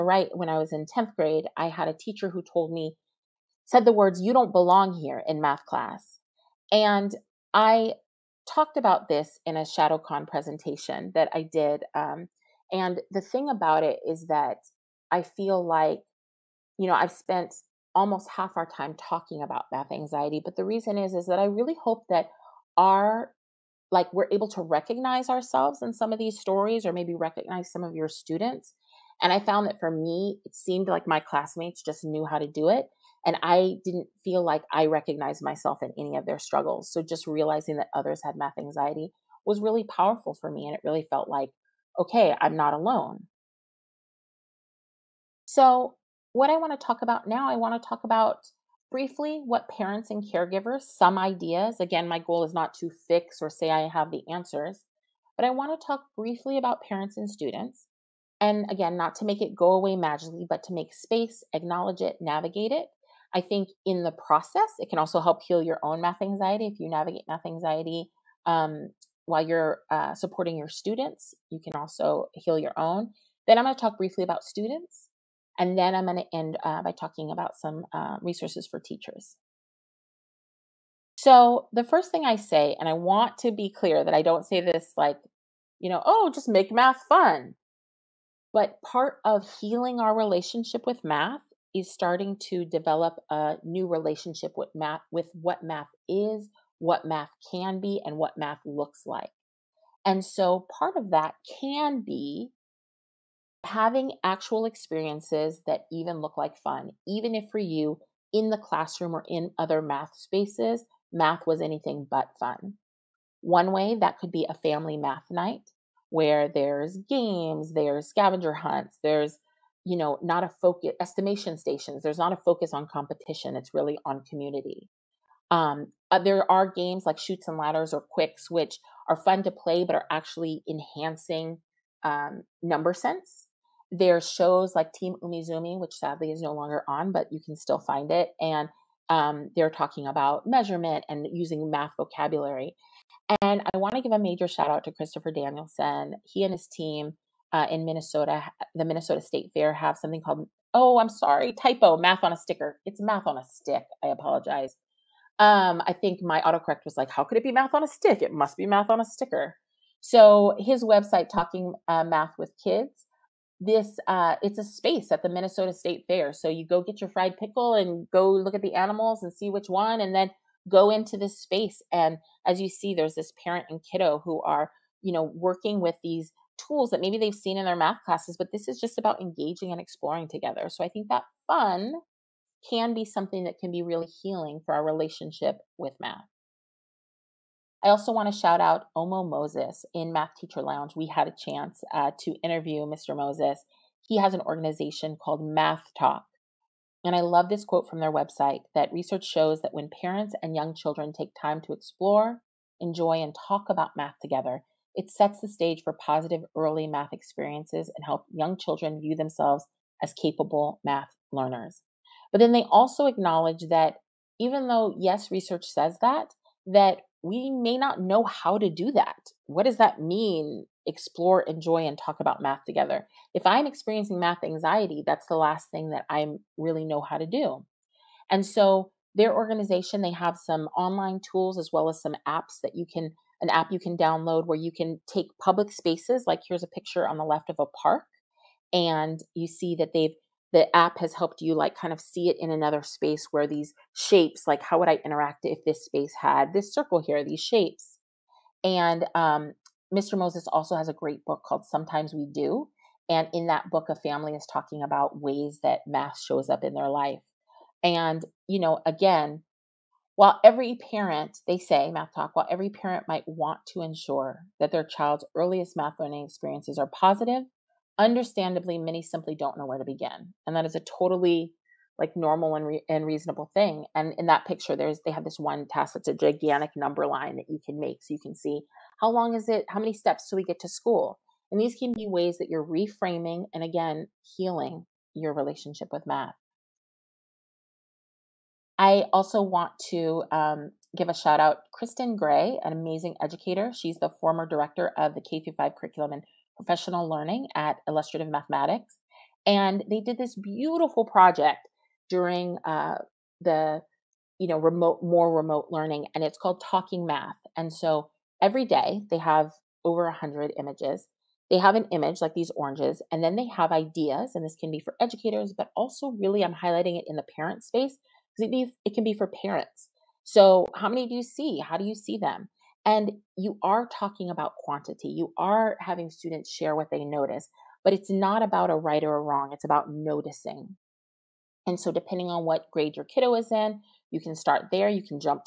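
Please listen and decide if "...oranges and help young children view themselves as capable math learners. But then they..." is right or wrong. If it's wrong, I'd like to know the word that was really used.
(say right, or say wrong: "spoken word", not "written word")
wrong: "experiences", not "oranges".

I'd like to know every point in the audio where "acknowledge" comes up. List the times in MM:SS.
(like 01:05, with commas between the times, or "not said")
01:01, 03:33.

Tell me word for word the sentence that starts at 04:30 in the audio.
And that is a totally like normal and, re- and reasonable thing.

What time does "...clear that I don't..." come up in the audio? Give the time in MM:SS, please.
01:23.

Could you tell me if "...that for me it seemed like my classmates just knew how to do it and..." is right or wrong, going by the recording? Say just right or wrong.
right.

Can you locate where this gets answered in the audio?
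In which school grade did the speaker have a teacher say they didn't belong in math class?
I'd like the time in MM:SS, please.
00:00.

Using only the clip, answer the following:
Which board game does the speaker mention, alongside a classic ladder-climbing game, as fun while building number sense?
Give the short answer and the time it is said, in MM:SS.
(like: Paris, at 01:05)
Qwixx, at 02:08.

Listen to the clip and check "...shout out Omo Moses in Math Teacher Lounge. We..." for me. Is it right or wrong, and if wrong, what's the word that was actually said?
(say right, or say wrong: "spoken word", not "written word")
right.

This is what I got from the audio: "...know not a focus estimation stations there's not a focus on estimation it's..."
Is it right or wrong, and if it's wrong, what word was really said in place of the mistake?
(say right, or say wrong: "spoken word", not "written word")
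wrong: "competition", not "estimation".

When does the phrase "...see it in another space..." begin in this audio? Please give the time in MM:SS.
04:02.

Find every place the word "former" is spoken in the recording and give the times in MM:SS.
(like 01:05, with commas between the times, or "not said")
04:54.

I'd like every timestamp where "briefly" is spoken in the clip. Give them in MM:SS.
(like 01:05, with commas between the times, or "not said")
00:48, 00:56, 01:13.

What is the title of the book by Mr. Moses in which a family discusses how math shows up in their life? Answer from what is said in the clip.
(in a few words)
Sometimes We Do.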